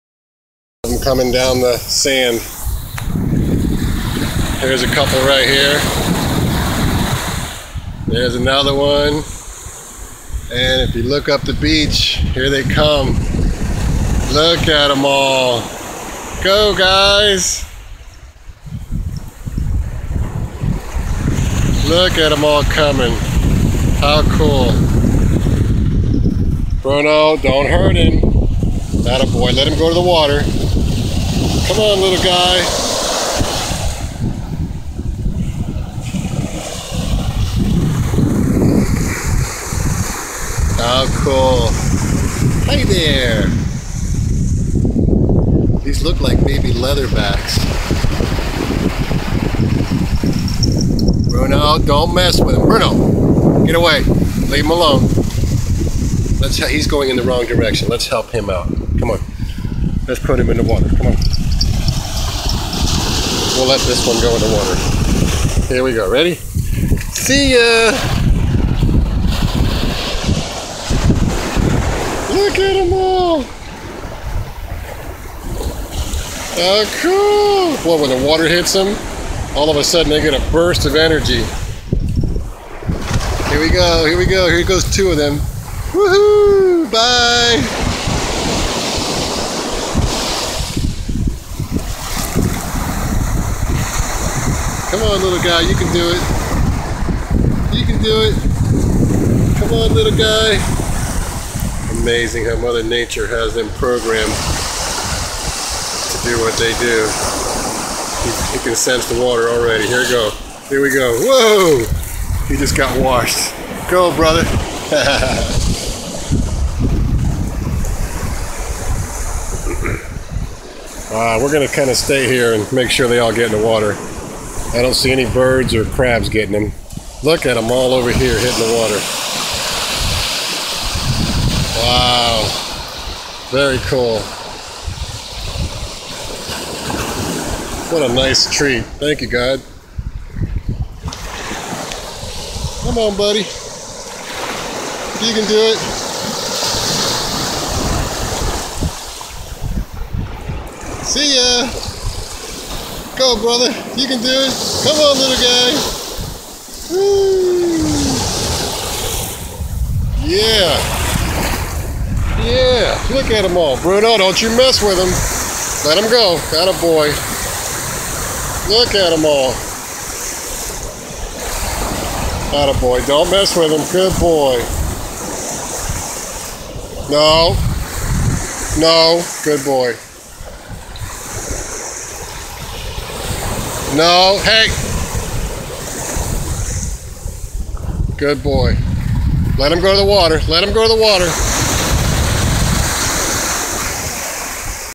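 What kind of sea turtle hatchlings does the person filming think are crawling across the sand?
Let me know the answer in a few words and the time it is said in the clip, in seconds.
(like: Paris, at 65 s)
leatherbacks, at 46 s.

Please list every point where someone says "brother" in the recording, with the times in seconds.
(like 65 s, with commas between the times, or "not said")
114 s, 153 s.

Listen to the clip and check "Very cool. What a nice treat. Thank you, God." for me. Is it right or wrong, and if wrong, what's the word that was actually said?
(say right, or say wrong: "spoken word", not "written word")
right.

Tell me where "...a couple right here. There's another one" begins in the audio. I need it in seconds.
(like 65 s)
4 s.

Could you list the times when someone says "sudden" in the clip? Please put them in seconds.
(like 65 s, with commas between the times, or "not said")
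79 s.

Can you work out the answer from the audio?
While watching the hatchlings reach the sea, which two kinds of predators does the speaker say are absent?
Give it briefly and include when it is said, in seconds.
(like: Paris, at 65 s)
birds or crabs, at 125 s.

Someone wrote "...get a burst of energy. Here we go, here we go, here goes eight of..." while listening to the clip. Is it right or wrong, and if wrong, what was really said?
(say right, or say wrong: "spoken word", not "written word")
wrong: "two", not "eight".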